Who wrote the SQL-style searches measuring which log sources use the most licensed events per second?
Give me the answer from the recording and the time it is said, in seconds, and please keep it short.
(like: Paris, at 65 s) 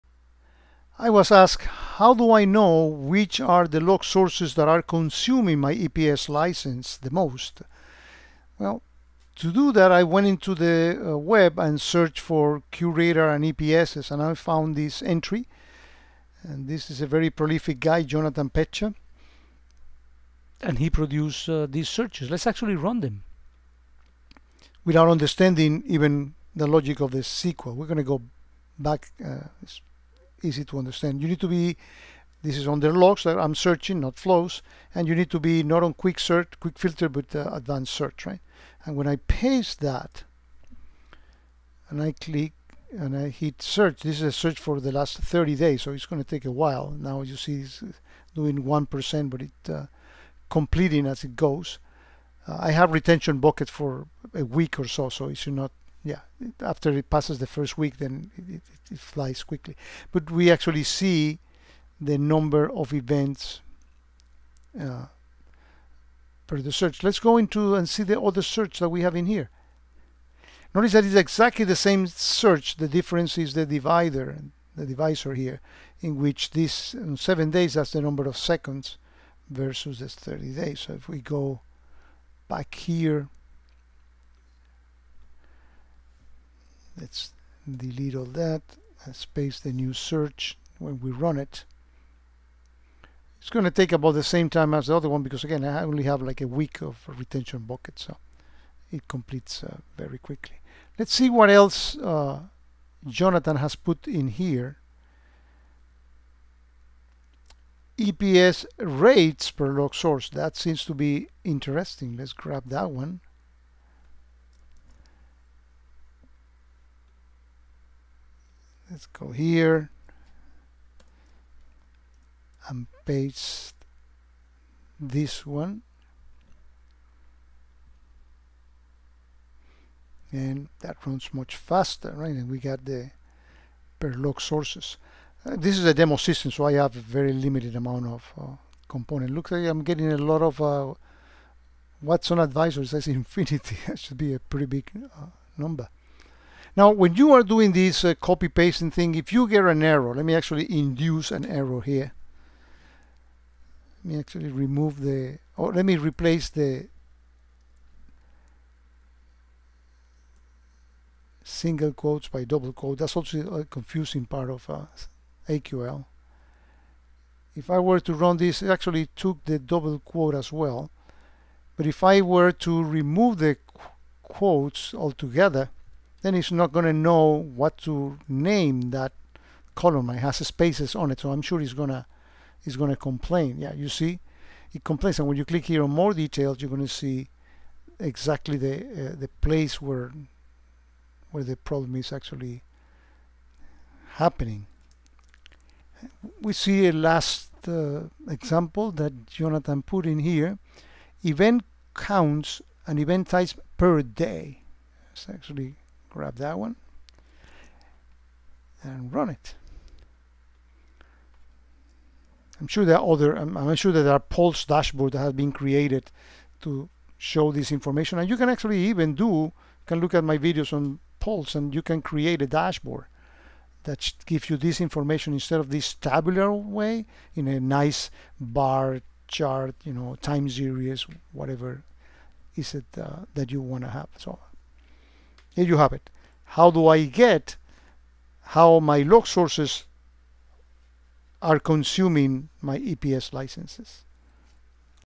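Jonathan Pechta, at 18 s.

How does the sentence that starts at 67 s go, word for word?
Let's go into and see the other search that we have in here.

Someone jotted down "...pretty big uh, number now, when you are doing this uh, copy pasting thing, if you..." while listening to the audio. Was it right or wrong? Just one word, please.
right.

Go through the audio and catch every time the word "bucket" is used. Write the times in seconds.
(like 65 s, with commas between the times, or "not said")
53 s, 97 s.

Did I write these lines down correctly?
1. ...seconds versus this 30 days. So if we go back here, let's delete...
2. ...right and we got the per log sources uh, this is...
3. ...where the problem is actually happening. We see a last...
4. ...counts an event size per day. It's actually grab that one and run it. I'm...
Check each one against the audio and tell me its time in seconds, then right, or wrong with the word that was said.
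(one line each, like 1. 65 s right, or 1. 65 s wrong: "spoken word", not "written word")
1. 78 s right
2. 132 s right
3. 191 s right
4. 201 s right.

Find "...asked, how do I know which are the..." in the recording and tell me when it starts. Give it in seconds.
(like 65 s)
1 s.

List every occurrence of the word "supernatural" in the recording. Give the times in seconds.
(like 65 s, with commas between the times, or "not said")
not said.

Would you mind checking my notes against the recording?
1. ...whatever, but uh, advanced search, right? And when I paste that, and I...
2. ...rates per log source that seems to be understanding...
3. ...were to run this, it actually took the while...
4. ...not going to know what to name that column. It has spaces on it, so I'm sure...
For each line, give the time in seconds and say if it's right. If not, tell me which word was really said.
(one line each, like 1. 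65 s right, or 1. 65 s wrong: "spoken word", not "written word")
1. 36 s wrong: "filter", not "whatever"
2. 108 s wrong: "interesting", not "understanding"
3. 167 s wrong: "double", not "while"
4. 176 s right.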